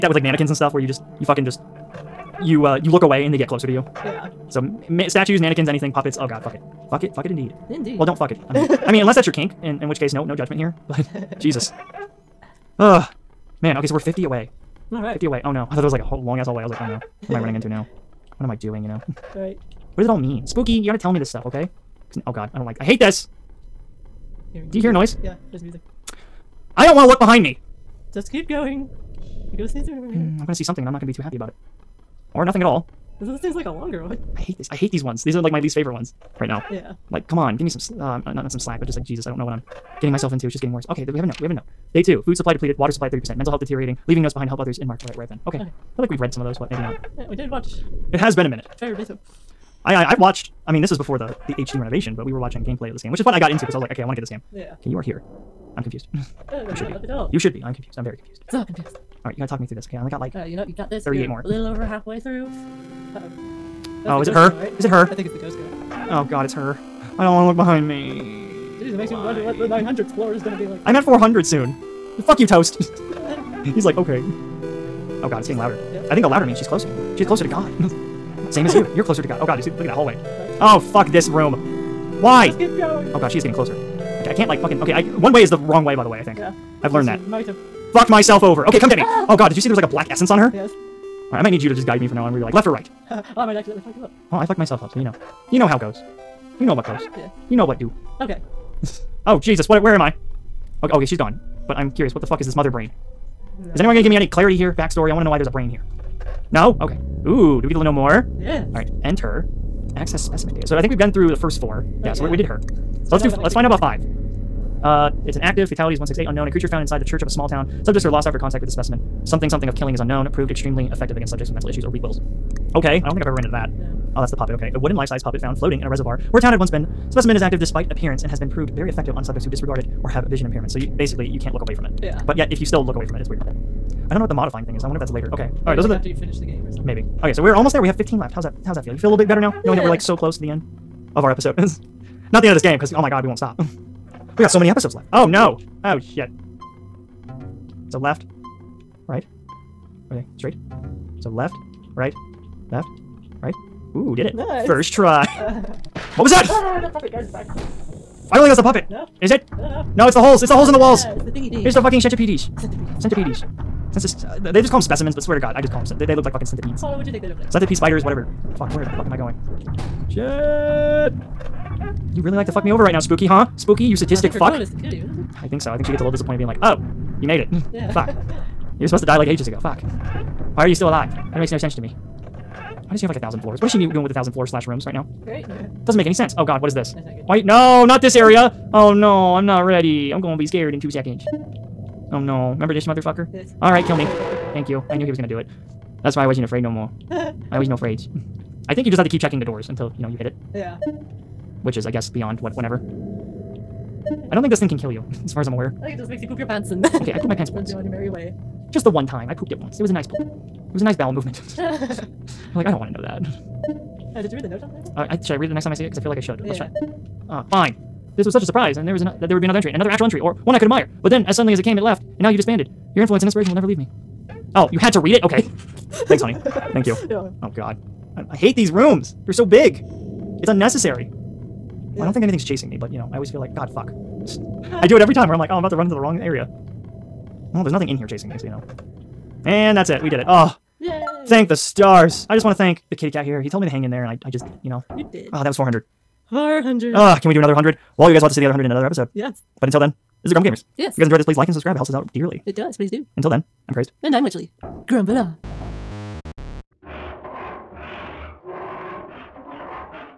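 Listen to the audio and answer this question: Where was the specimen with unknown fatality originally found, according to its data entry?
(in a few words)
inside the church of a small town.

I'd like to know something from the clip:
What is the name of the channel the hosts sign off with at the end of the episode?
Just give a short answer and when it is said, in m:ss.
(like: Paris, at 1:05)
Grumble Gamers, at 4:10.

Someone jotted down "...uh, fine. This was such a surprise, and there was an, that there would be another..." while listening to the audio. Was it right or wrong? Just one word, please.
right.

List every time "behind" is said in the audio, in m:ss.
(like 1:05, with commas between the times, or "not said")
0:27, 0:44, 1:07.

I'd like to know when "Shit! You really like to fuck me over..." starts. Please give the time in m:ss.
2:50.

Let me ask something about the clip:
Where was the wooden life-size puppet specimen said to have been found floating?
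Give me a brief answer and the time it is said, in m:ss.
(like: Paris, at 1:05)
in a reservoir, at 2:05.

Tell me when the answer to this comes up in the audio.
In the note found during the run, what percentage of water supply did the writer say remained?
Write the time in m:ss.
0:42.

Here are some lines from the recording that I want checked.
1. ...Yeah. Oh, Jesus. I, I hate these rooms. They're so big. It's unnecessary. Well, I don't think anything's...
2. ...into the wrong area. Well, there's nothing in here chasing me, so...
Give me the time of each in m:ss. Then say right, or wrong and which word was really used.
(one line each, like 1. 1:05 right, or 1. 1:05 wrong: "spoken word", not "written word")
1. 3:47 wrong: "God", not "Jesus"
2. 3:55 right.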